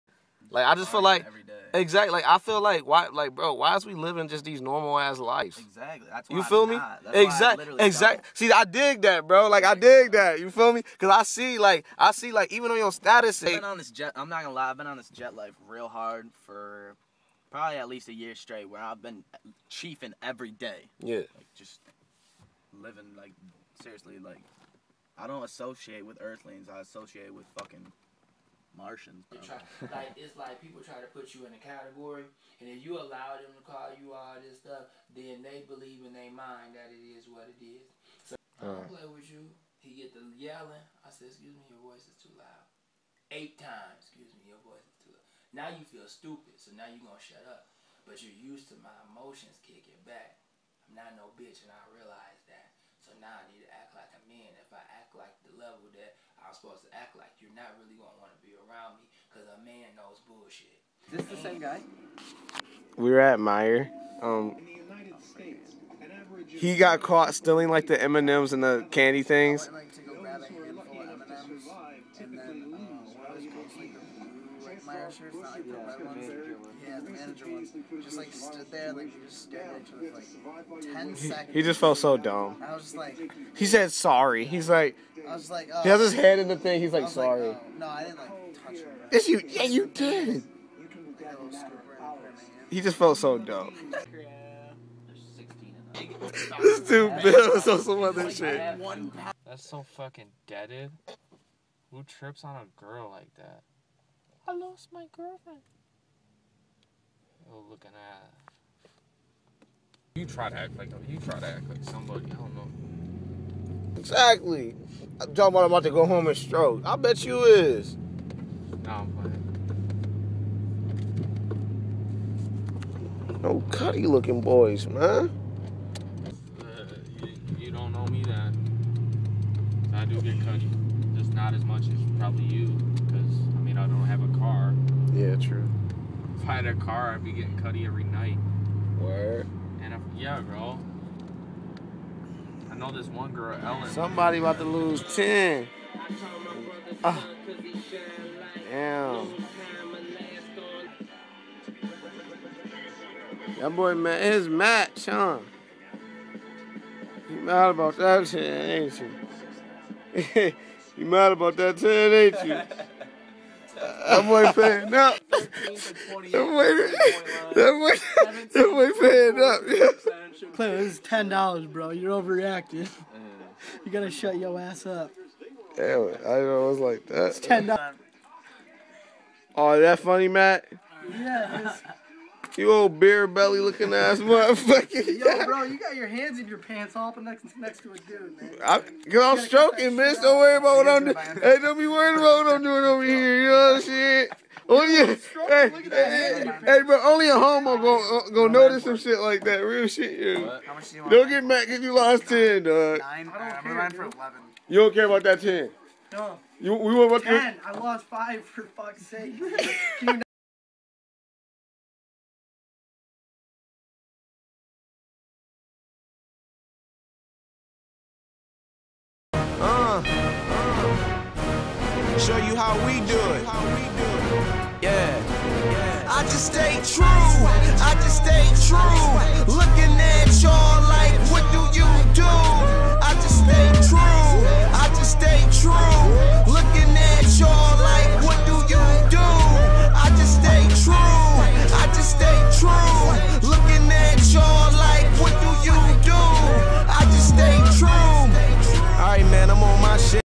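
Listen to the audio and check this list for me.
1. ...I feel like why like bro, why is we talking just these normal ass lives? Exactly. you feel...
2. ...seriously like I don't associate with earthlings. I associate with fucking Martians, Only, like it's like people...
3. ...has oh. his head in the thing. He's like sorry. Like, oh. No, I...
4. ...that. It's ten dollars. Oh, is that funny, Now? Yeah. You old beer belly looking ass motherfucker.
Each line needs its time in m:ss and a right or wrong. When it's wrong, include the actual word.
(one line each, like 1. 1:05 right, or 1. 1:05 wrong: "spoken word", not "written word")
1. 0:02 wrong: "living", not "talking"
2. 0:23 wrong: "Try", not "Only"
3. 1:25 right
4. 2:57 wrong: "Matt", not "Now".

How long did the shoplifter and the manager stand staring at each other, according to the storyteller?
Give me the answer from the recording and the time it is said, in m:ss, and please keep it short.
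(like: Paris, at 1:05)
10 seconds, at 1:20.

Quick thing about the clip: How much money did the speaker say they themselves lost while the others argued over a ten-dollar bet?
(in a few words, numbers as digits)
5.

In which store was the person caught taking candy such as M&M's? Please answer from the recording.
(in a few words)
Meijer.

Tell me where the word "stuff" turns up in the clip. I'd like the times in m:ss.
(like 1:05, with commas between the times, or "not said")
0:34.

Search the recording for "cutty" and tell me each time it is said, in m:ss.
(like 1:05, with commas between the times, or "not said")
2:03, 2:10, 2:17.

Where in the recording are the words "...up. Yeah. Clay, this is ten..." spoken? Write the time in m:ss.
2:49.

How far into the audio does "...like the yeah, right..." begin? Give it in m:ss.
1:15.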